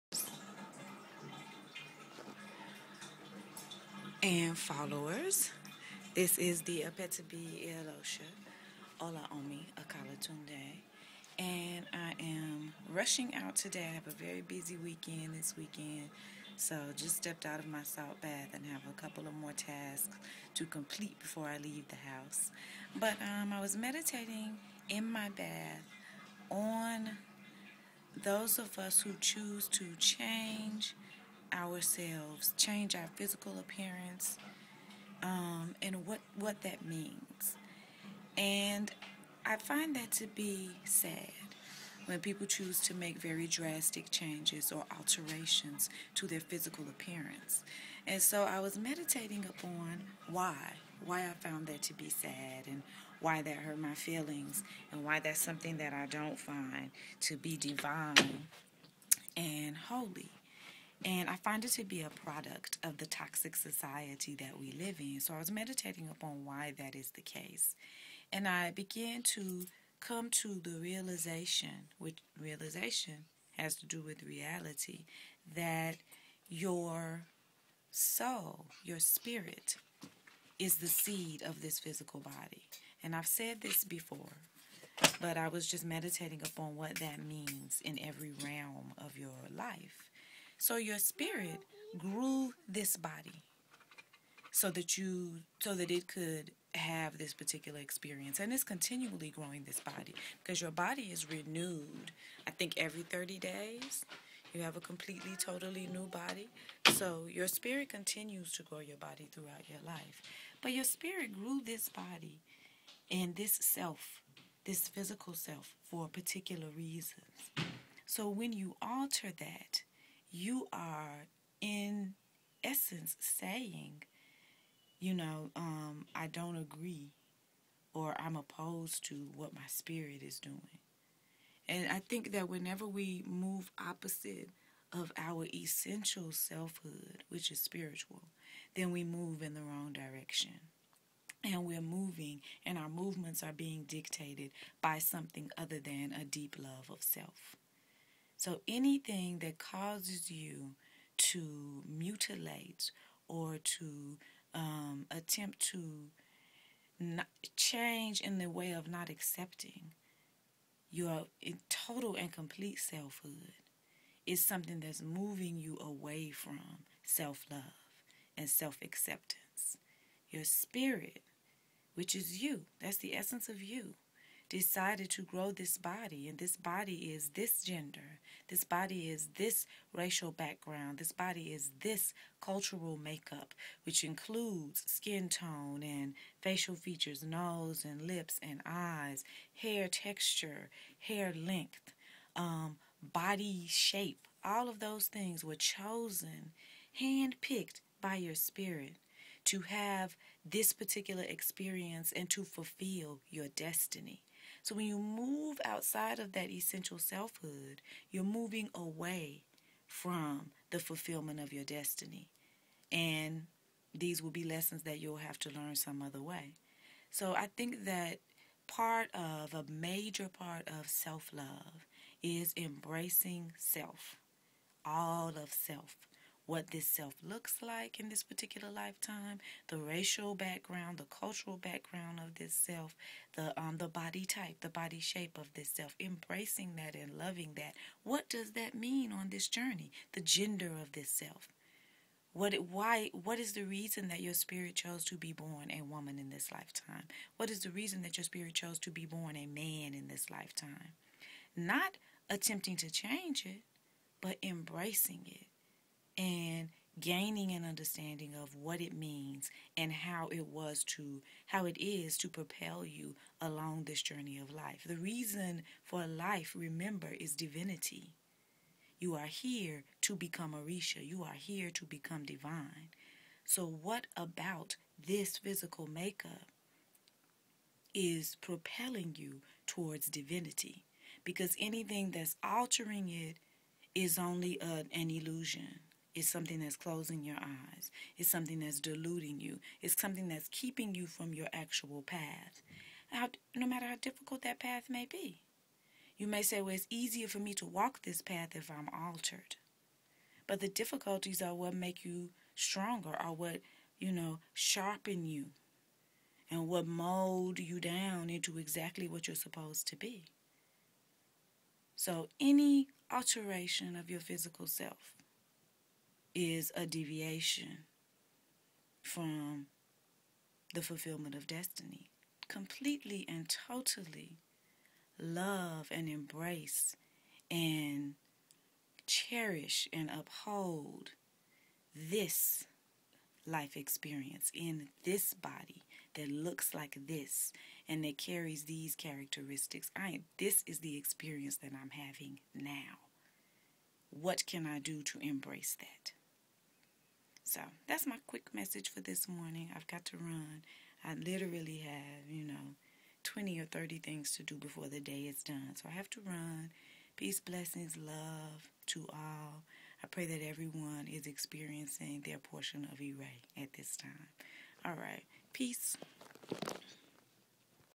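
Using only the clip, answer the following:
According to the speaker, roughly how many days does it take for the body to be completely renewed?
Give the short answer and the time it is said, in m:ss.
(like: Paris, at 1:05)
30, at 1:43.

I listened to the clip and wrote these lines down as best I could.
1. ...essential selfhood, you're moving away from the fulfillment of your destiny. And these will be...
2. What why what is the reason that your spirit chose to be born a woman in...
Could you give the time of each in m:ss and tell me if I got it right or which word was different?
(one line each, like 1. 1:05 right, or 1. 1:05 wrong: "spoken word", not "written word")
1. 3:26 right
2. 4:02 right.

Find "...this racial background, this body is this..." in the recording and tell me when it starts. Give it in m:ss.
2:59.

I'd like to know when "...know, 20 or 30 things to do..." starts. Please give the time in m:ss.
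5:52.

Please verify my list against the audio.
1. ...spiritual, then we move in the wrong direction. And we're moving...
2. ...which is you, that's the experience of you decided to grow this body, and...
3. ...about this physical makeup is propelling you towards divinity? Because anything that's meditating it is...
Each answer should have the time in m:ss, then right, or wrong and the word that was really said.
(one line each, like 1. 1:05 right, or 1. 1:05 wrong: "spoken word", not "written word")
1. 2:17 right
2. 2:51 wrong: "essence", not "experience"
3. 4:34 wrong: "altering", not "meditating".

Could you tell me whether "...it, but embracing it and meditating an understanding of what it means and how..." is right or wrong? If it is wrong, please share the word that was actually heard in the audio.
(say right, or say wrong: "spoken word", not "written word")
wrong: "gaining", not "meditating".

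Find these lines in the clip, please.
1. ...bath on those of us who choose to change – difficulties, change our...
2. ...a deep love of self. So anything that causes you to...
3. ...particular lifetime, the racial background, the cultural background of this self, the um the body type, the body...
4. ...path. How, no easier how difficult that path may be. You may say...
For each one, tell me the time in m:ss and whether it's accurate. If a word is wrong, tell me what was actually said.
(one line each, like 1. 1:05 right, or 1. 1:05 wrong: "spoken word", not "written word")
1. 0:25 wrong: "ourselves", not "difficulties"
2. 2:26 right
3. 3:48 right
4. 4:52 wrong: "matter", not "easier".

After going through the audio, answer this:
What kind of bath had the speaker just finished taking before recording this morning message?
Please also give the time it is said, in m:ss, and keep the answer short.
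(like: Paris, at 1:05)
salt bath, at 0:17.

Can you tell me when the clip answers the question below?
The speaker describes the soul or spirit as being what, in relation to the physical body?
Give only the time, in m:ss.
1:20.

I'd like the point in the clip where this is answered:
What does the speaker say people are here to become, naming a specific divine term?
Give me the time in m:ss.
4:30.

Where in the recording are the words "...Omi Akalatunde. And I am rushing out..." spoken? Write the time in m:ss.
0:09.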